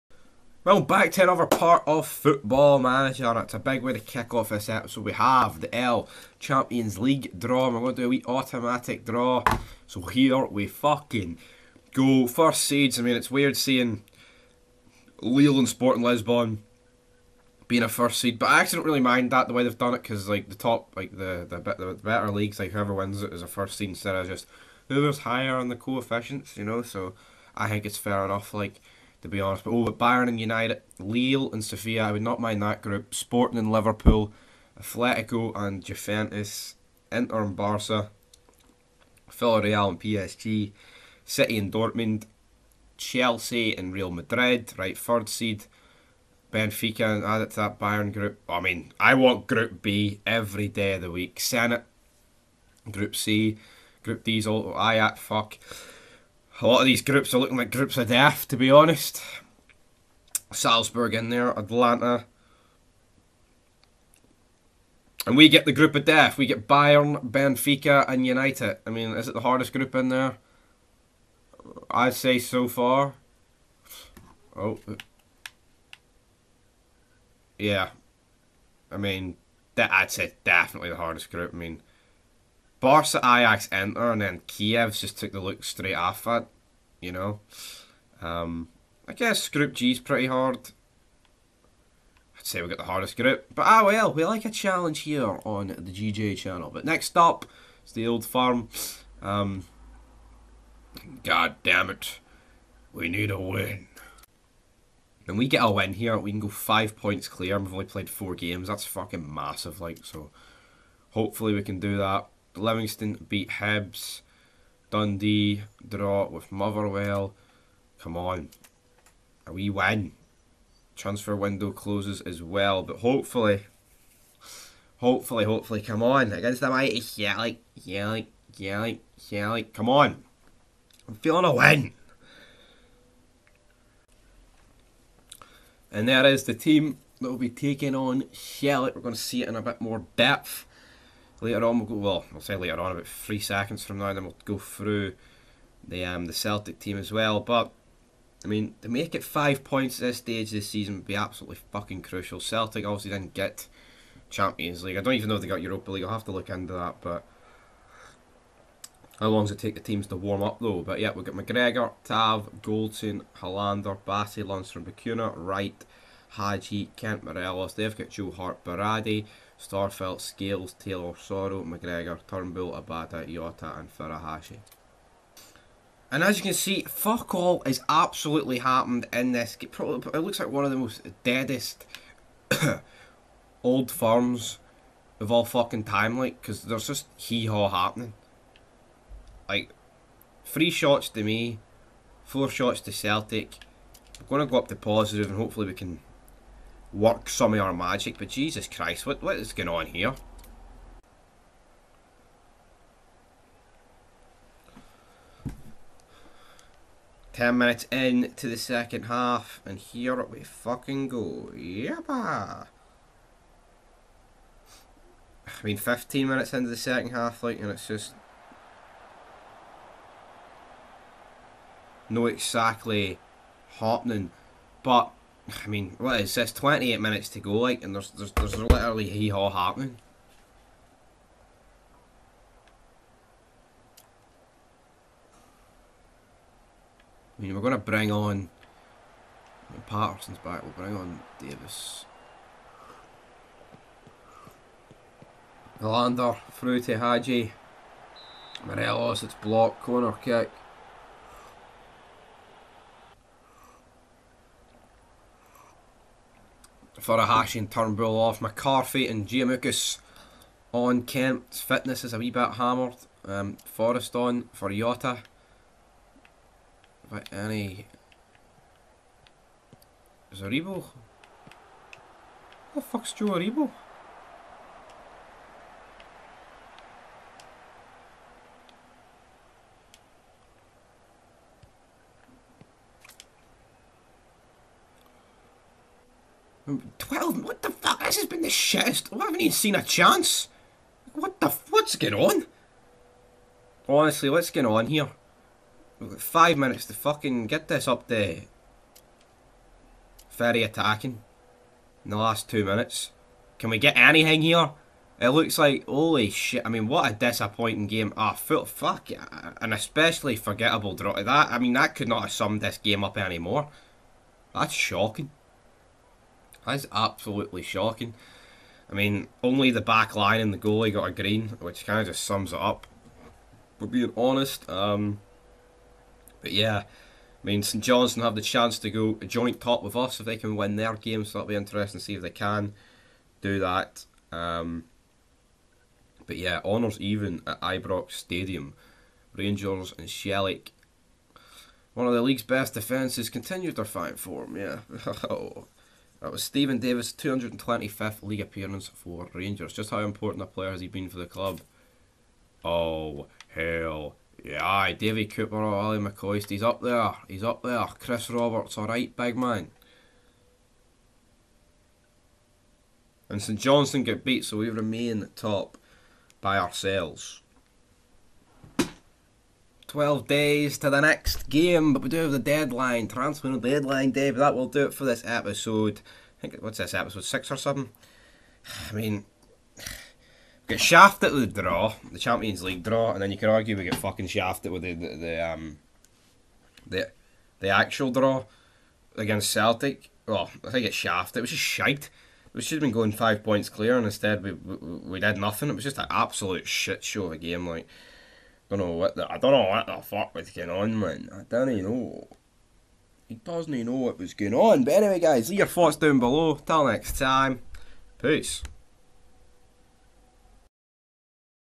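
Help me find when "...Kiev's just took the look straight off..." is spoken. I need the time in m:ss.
1:24.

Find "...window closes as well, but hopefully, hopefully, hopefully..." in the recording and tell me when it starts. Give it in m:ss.
2:01.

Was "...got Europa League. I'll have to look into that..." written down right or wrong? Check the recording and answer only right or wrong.
right.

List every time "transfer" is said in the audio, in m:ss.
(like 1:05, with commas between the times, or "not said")
2:00, 6:13.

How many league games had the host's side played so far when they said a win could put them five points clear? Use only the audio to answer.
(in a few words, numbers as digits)
4.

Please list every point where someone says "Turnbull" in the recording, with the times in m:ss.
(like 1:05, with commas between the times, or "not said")
2:52, 4:17.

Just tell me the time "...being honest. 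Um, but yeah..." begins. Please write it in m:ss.
5:23.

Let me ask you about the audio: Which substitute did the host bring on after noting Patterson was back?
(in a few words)
Davis.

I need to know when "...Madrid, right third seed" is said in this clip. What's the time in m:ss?
0:44.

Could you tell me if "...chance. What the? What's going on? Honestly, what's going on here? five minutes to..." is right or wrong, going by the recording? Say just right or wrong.
right.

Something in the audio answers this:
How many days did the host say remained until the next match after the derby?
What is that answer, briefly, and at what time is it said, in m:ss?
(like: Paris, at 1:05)
12, at 6:09.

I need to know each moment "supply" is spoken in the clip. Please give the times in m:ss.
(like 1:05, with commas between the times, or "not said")
not said.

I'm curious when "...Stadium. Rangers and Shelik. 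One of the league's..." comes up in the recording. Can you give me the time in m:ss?
5:38.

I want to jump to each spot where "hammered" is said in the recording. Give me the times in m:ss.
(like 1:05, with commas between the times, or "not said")
4:22.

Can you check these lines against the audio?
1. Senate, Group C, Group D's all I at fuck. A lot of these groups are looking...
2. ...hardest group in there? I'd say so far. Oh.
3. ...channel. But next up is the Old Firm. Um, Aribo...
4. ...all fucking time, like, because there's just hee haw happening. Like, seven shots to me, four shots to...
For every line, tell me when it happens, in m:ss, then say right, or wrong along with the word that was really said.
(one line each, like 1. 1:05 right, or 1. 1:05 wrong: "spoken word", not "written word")
1. 0:51 right
2. 1:09 right
3. 1:36 wrong: "God", not "Aribo"
4. 3:05 wrong: "three", not "seven".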